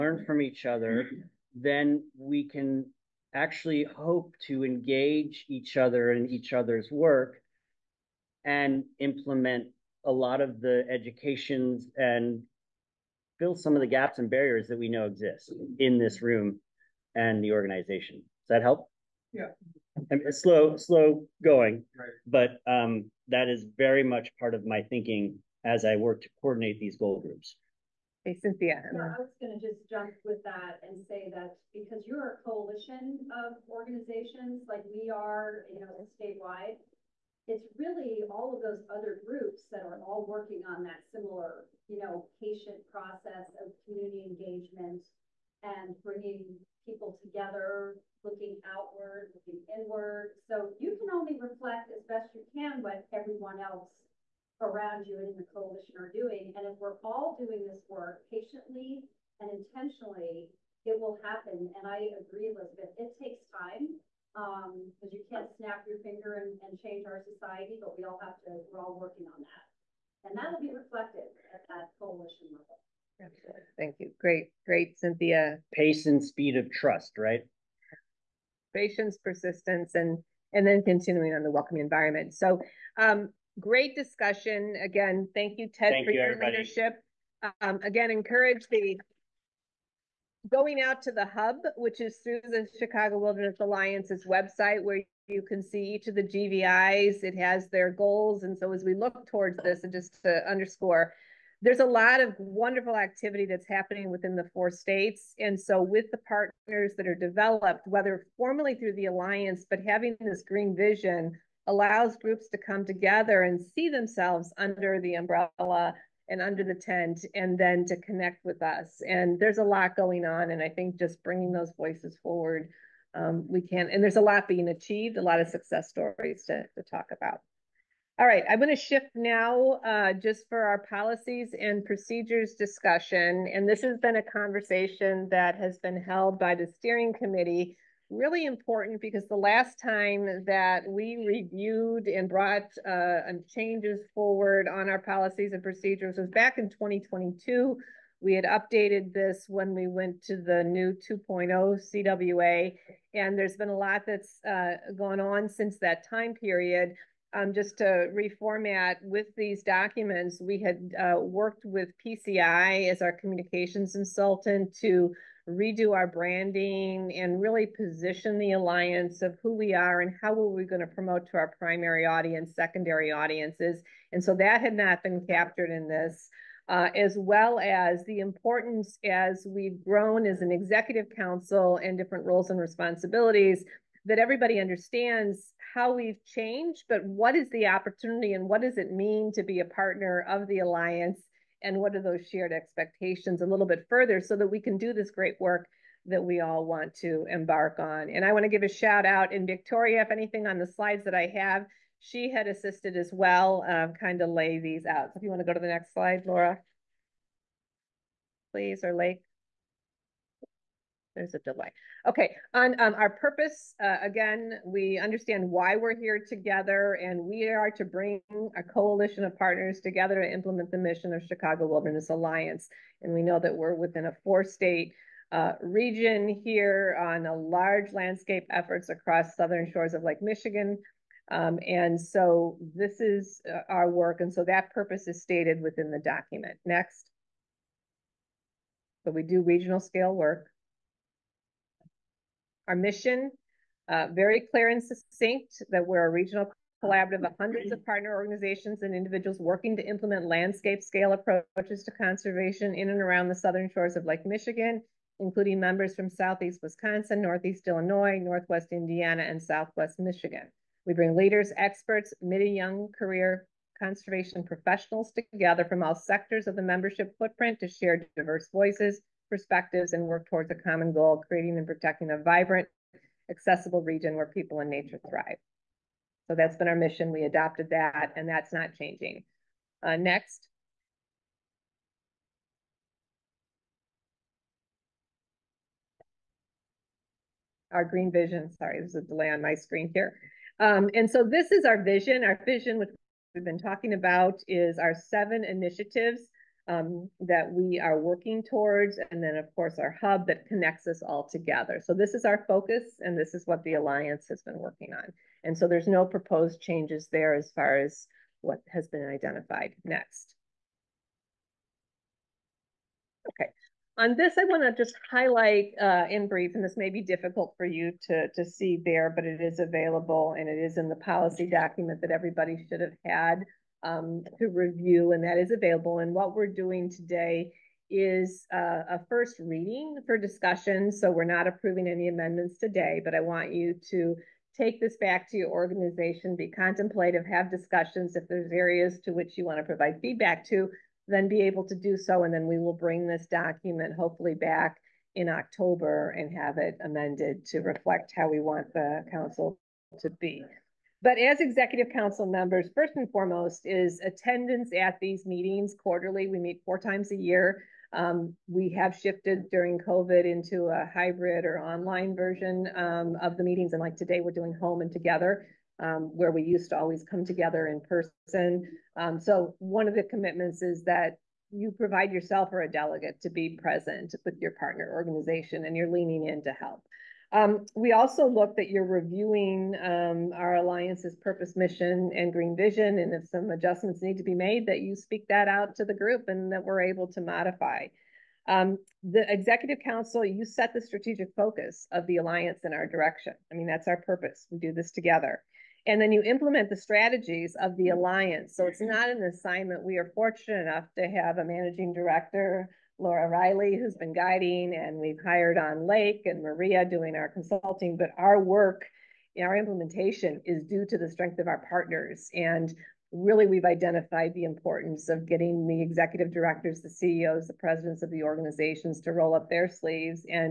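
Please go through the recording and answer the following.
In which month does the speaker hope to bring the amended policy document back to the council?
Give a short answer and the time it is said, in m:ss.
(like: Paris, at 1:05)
October, at 5:45.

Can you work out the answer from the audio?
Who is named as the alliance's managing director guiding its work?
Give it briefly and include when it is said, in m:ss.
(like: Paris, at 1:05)
Laura Riley, at 6:42.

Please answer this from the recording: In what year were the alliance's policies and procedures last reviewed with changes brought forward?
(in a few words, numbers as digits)
2022.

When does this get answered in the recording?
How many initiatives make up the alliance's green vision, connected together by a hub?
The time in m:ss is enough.
4:54.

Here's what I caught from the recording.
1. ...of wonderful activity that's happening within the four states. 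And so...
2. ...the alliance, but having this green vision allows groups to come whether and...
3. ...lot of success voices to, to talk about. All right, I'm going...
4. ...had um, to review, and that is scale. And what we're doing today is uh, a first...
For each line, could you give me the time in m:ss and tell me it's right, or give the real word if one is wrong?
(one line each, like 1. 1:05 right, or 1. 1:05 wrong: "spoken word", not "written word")
1. 1:42 right
2. 1:48 wrong: "together", not "whether"
3. 2:05 wrong: "stories", not "voices"
4. 5:23 wrong: "available", not "scale".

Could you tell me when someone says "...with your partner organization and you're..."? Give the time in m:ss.
6:14.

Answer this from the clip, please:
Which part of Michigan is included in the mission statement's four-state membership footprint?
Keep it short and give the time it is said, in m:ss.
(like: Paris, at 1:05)
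Southwest Michigan, at 4:19.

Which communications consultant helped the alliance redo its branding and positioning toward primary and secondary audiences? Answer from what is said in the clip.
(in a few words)
PCI.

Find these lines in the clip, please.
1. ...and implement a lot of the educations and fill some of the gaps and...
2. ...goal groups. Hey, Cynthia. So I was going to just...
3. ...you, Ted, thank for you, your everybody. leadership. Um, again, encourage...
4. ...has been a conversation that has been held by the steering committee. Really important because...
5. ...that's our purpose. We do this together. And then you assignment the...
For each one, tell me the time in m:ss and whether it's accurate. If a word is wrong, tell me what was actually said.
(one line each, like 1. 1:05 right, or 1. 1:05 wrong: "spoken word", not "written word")
1. 0:08 right
2. 0:26 right
3. 1:25 right
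4. 2:13 right
5. 6:33 wrong: "implement", not "assignment".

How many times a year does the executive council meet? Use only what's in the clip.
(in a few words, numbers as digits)
4.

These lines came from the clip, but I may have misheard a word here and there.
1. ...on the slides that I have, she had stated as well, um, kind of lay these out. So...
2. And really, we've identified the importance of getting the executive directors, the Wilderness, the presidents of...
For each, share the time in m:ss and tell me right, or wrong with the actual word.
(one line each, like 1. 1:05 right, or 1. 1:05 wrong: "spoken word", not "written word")
1. 3:20 wrong: "assisted", not "stated"
2. 6:52 wrong: "CEOs", not "Wilderness".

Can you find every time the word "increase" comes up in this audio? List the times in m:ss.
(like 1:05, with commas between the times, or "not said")
not said.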